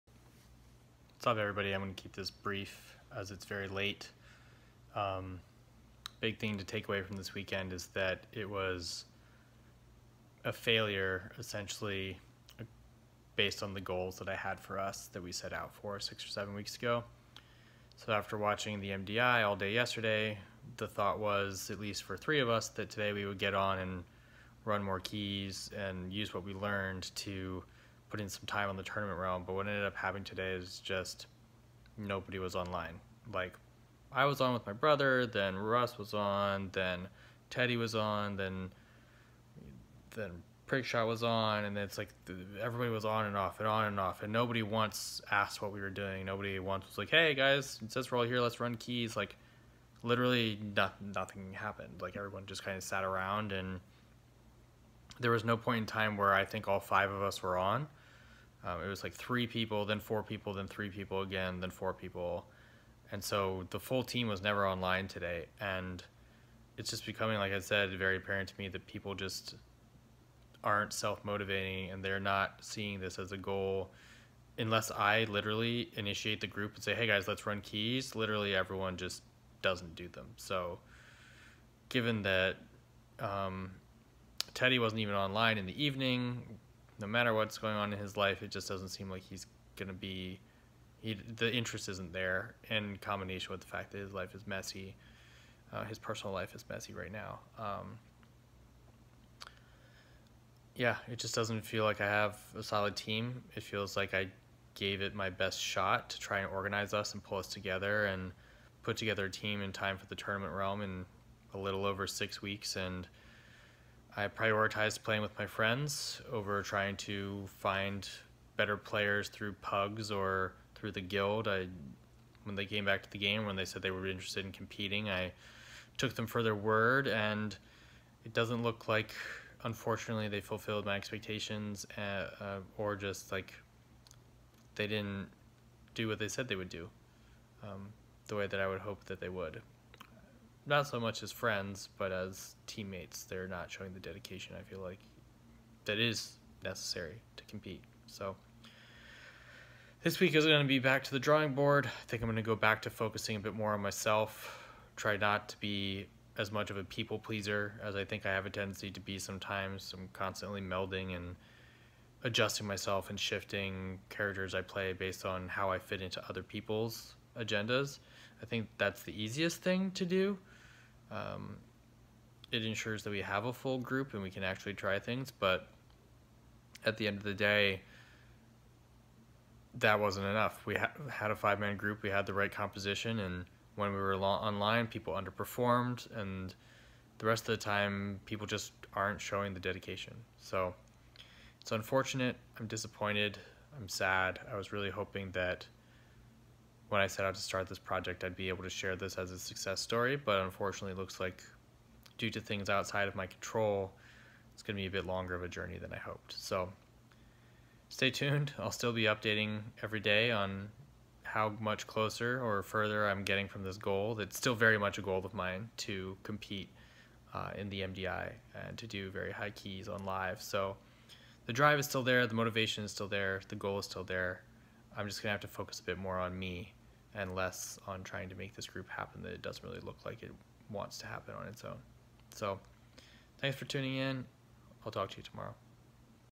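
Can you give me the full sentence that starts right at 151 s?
I think I'm going to go back to focusing a bit more on myself.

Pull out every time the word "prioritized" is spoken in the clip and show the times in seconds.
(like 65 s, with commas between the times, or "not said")
114 s.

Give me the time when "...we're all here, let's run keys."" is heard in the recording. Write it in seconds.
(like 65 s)
48 s.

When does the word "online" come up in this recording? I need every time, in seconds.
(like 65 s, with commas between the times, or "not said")
32 s, 64 s, 85 s, 184 s.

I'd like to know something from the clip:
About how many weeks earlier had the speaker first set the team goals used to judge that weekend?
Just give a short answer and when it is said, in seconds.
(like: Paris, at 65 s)
6 or 7 weeks, at 15 s.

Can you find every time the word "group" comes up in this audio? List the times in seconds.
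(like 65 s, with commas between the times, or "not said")
76 s, 173 s, 181 s, 228 s.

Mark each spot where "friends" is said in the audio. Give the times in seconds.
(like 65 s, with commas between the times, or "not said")
115 s, 141 s.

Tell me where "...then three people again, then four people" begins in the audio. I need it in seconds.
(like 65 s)
60 s.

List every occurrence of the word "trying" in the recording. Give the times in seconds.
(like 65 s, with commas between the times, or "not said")
116 s, 228 s.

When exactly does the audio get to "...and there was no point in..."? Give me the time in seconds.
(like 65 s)
53 s.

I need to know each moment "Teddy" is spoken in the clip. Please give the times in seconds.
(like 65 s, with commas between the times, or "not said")
37 s, 84 s.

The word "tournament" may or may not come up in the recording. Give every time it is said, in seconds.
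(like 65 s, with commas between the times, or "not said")
28 s, 110 s.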